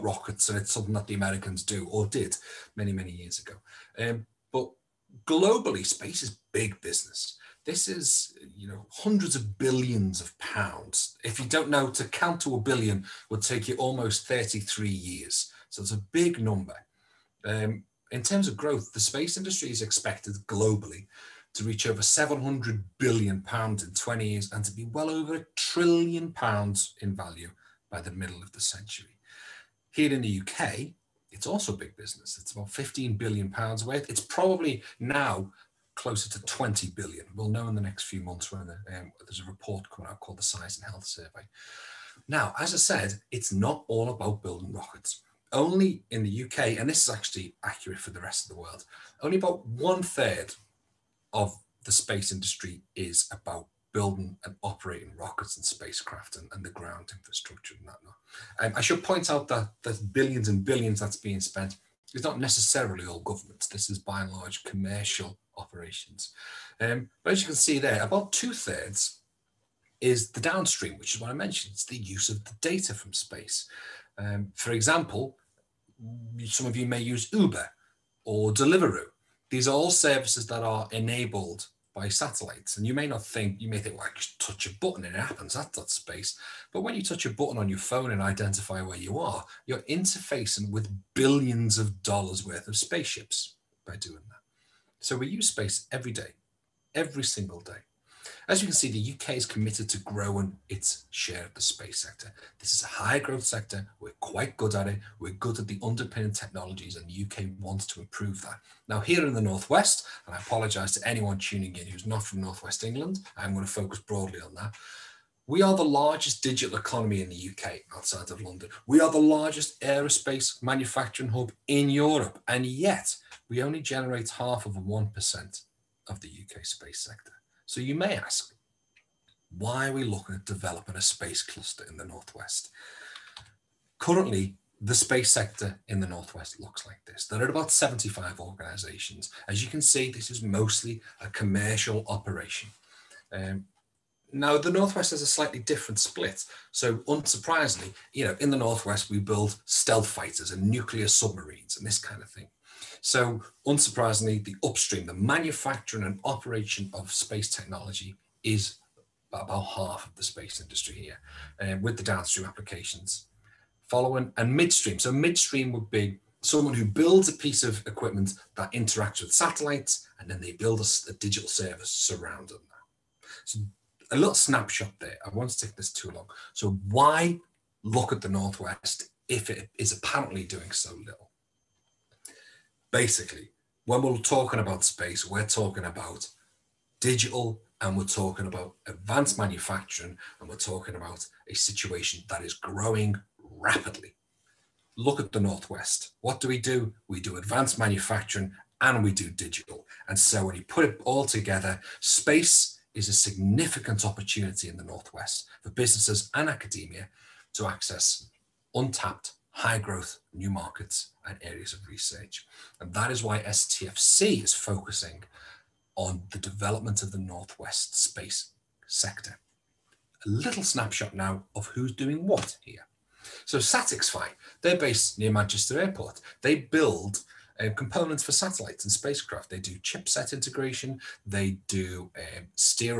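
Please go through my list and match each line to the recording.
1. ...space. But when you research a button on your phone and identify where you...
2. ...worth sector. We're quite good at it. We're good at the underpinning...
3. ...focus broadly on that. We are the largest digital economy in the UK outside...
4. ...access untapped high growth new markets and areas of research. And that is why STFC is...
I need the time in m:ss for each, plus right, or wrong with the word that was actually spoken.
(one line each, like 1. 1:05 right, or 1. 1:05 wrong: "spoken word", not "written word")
1. 1:25 wrong: "touch", not "research"
2. 1:43 wrong: "growth", not "worth"
3. 1:53 right
4. 3:27 right.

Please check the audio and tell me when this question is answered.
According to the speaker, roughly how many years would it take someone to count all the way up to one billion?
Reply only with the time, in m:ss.
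0:13.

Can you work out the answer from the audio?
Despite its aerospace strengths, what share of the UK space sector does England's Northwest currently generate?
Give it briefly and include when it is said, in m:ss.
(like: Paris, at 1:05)
half of 1%, at 2:04.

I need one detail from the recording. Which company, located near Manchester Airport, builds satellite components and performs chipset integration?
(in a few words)
SatixFy.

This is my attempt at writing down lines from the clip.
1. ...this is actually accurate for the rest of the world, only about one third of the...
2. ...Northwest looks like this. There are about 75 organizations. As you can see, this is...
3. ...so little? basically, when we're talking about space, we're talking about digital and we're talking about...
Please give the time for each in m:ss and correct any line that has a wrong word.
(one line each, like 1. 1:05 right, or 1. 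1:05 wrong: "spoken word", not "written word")
1. 0:46 right
2. 2:16 right
3. 3:00 right.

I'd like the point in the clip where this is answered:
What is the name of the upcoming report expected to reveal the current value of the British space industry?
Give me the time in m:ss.
0:40.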